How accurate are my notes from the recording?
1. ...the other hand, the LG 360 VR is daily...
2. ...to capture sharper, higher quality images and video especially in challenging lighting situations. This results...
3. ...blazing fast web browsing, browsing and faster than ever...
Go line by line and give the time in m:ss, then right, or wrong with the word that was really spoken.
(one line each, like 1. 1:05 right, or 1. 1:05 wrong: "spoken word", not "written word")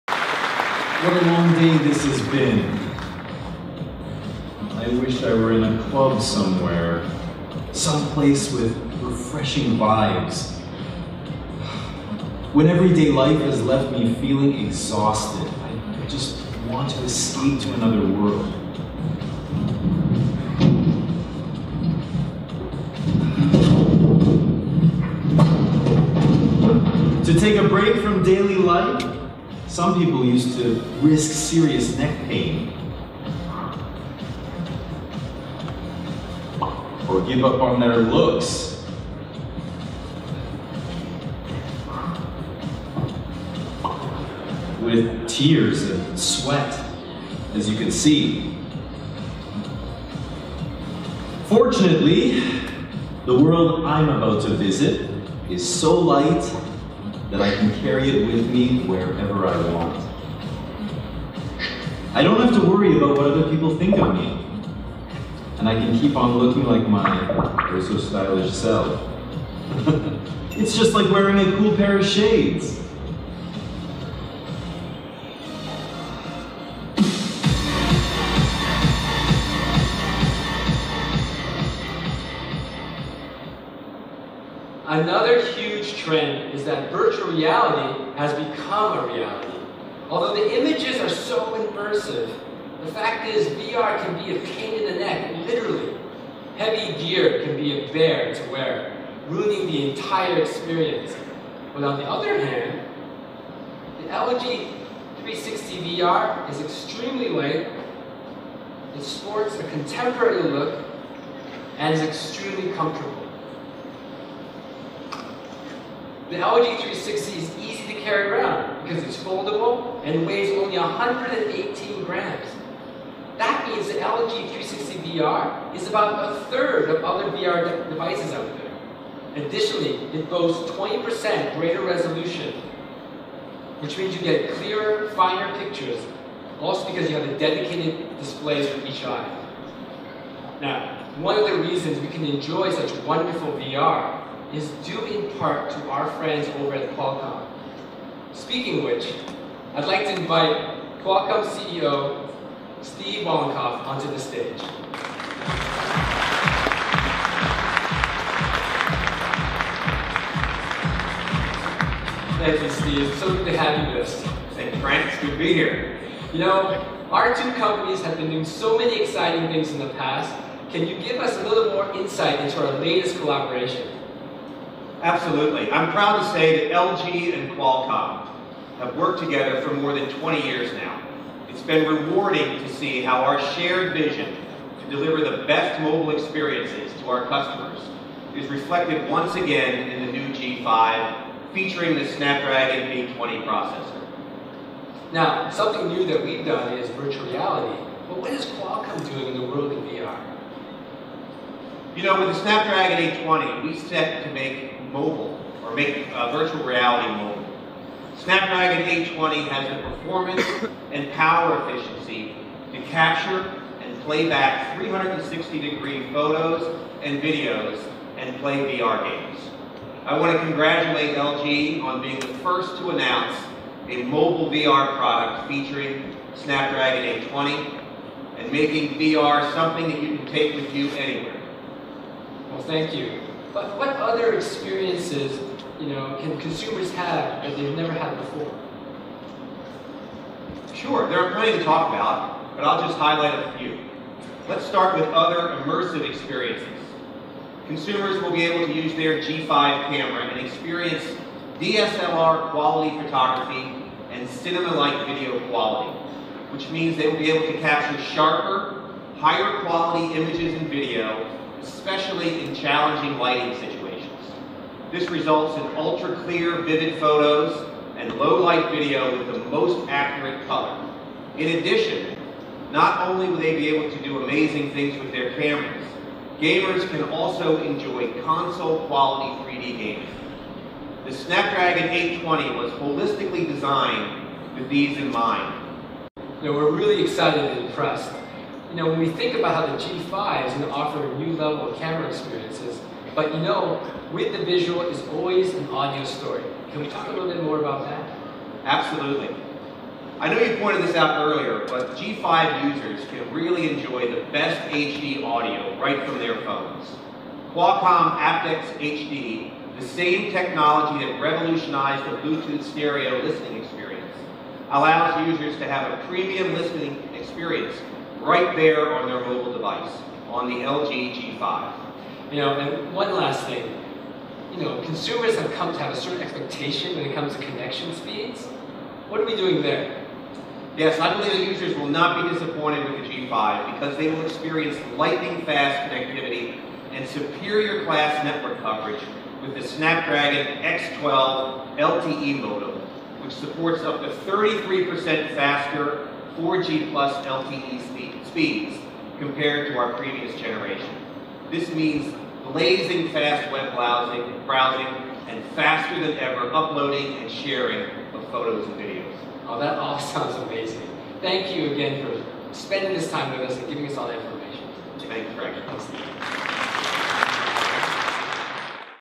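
1. 1:41 wrong: "extremely", not "daily"
2. 4:17 right
3. 5:52 right.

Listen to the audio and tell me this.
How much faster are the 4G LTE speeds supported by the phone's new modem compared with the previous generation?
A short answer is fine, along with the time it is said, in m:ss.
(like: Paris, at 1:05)
33%, at 5:44.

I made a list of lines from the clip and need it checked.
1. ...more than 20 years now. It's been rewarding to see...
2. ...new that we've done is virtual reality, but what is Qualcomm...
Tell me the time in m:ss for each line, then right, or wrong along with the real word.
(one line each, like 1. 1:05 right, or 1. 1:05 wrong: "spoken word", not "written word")
1. 2:59 right
2. 3:15 right.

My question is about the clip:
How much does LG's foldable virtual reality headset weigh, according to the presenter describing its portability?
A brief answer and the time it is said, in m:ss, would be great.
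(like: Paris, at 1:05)
118 grams, at 2:00.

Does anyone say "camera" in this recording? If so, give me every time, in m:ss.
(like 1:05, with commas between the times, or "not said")
4:09, 4:35, 4:51.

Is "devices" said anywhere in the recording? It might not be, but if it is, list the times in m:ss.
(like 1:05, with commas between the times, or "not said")
2:07, 5:19.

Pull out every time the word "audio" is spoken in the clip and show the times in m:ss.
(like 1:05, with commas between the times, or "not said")
4:55, 5:05.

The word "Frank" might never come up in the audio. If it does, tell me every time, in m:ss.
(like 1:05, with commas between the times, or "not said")
2:44, 6:05.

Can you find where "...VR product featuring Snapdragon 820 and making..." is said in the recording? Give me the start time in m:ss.
3:44.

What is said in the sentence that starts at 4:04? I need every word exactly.
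Let's start with other immersive experiences.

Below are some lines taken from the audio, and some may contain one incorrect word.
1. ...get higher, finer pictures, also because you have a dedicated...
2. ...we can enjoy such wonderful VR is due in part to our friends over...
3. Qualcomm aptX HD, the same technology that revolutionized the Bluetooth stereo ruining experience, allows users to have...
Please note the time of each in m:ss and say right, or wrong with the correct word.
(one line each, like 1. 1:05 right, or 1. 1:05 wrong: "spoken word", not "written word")
1. 2:14 wrong: "clearer", not "higher"
2. 2:21 right
3. 5:07 wrong: "listening", not "ruining".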